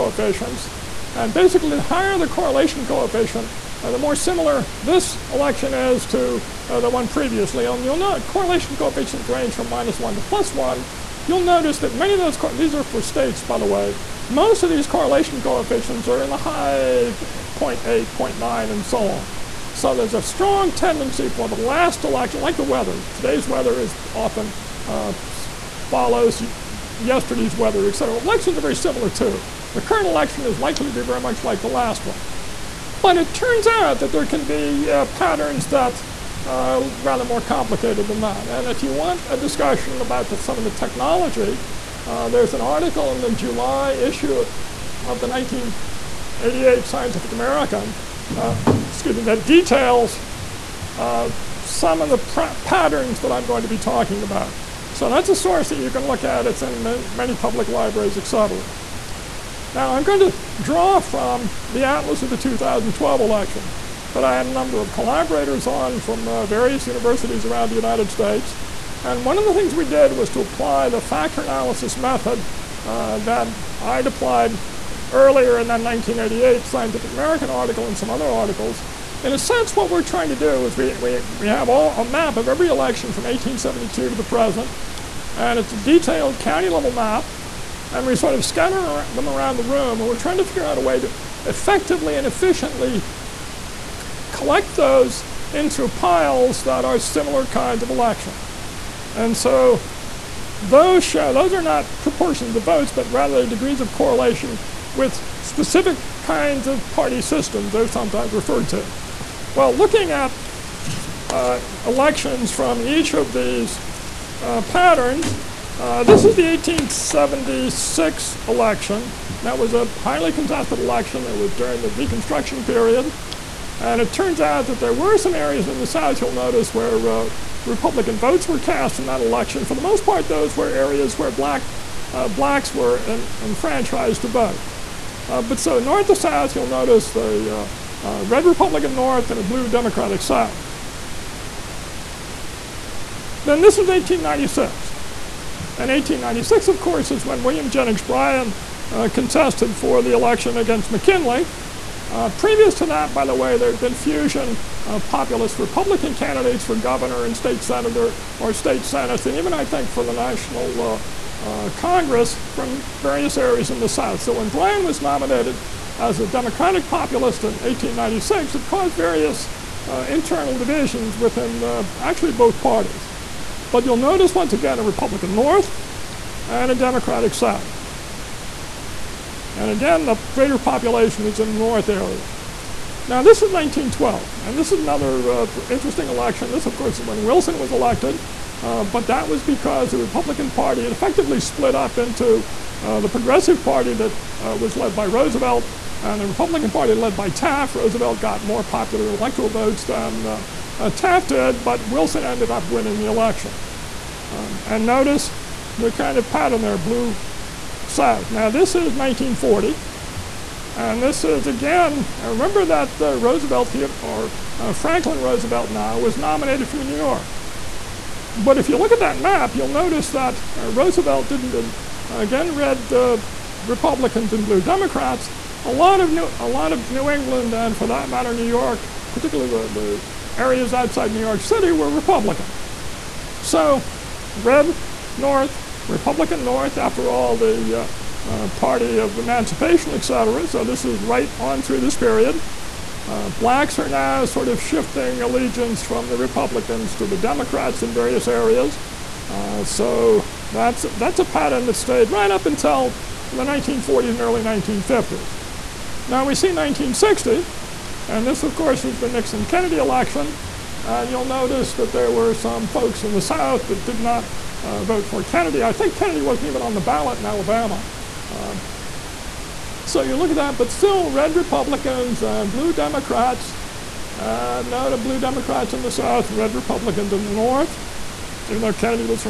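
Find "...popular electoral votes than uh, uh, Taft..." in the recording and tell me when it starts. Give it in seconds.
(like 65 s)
198 s.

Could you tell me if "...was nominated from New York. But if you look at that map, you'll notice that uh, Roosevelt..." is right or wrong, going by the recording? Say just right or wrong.
right.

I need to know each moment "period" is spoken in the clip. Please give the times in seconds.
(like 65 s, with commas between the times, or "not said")
122 s, 241 s.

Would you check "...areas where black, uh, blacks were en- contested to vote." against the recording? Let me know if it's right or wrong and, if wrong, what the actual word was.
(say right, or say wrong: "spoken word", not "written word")
wrong: "enfranchised", not "contested".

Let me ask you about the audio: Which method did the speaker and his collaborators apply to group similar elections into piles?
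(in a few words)
factor analysis.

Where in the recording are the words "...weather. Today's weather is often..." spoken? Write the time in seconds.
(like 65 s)
22 s.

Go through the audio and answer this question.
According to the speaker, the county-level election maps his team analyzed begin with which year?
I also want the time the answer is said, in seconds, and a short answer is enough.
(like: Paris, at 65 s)
1872, at 83 s.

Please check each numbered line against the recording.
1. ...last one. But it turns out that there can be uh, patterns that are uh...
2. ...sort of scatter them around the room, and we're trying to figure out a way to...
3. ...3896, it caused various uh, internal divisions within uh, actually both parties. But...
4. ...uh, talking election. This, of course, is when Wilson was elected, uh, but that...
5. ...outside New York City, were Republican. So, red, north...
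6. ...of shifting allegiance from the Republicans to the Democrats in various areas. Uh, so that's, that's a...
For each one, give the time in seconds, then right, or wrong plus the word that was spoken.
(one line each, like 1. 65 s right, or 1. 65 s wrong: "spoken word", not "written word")
1. 31 s right
2. 88 s right
3. 167 s wrong: "1896", not "3896"
4. 185 s wrong: "interesting", not "talking"
5. 230 s right
6. 244 s right.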